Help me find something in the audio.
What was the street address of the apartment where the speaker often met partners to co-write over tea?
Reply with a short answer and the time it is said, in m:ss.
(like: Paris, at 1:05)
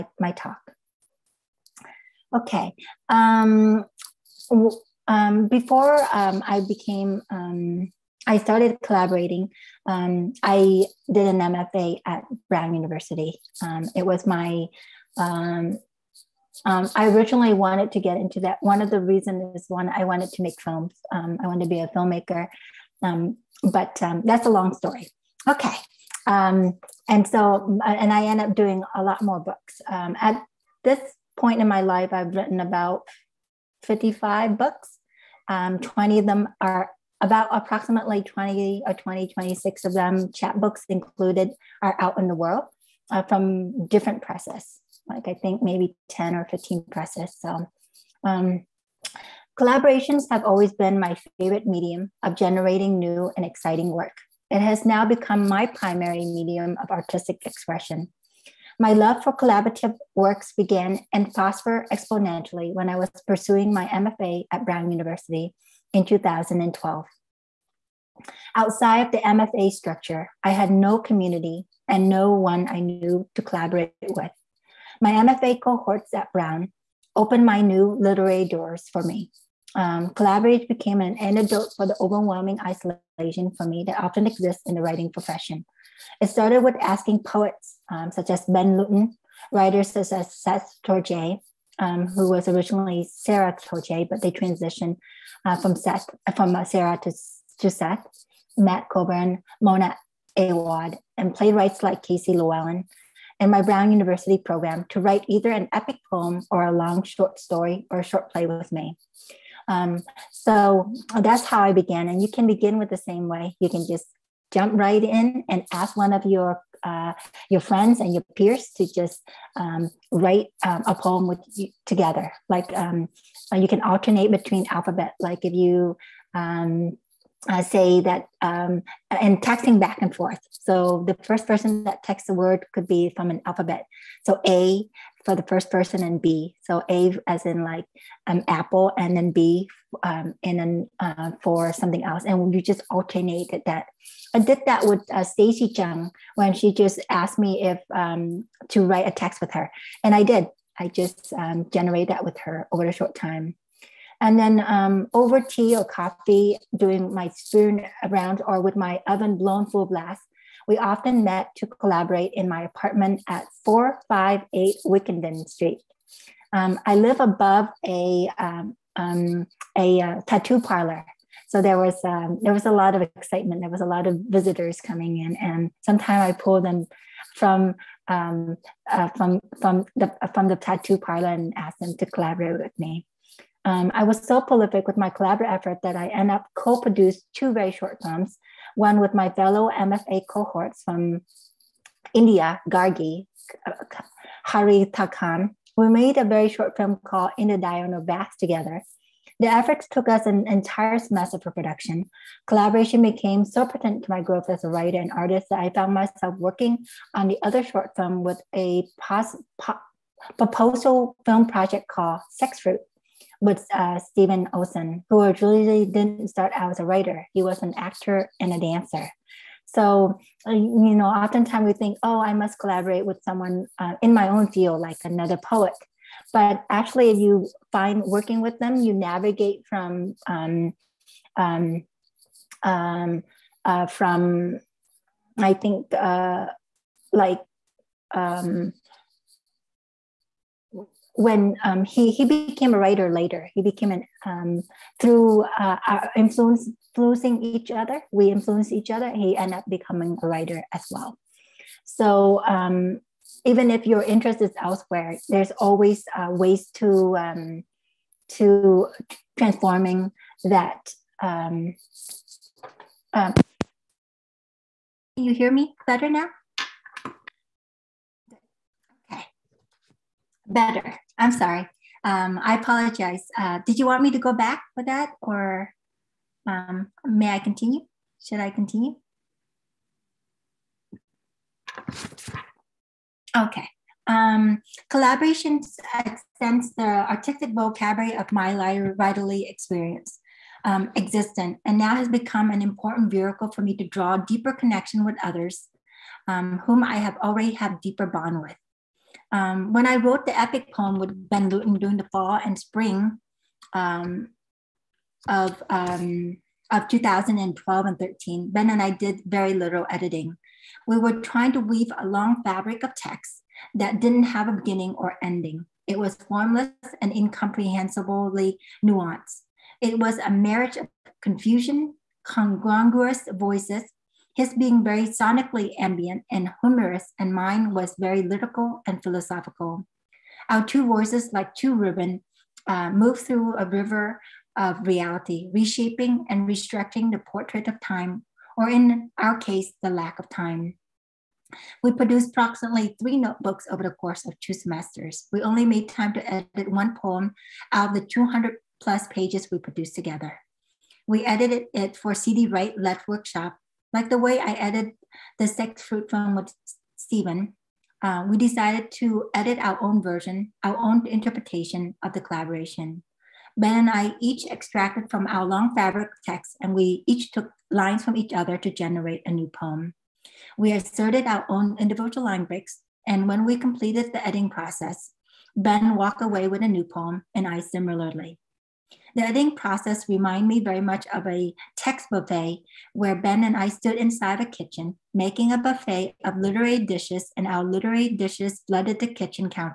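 458 Wickenden Street, at 2:43.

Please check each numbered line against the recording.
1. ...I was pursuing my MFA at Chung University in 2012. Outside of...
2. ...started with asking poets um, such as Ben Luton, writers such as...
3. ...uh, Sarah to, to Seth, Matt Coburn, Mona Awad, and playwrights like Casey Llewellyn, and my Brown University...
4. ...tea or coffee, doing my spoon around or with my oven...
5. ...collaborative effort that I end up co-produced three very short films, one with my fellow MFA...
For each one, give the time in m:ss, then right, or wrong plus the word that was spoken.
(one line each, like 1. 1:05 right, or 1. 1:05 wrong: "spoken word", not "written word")
1. 1:02 wrong: "Brown", not "Chung"
2. 1:26 right
3. 1:36 right
4. 2:35 right
5. 3:05 wrong: "two", not "three".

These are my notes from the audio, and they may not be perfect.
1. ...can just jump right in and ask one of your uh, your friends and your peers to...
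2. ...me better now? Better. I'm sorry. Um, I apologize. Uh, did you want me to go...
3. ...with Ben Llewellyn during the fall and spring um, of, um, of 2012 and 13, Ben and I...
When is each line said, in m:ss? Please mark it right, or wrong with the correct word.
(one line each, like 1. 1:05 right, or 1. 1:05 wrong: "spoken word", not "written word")
1. 1:53 right
2. 4:25 right
3. 5:00 wrong: "Luton", not "Llewellyn".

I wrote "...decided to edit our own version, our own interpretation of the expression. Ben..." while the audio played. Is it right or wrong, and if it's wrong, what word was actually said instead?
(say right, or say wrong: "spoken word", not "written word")
wrong: "collaboration", not "expression".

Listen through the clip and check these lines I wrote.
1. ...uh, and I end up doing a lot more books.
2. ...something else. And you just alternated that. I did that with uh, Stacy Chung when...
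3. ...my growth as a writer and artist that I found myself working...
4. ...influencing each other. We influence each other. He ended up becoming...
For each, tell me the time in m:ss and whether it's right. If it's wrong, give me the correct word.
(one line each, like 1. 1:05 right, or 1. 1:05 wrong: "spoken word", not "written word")
1. 0:27 right
2. 2:21 right
3. 3:24 right
4. 4:06 right.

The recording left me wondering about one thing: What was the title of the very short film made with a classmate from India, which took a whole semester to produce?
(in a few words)
In the Diurnal Bath.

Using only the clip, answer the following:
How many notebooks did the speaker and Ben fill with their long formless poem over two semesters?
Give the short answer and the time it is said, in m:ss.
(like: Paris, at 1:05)
3, at 5:43.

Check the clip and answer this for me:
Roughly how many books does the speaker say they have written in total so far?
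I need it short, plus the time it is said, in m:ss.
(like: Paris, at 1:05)
55, at 0:33.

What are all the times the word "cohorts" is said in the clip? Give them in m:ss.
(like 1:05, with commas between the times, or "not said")
1:15, 3:10.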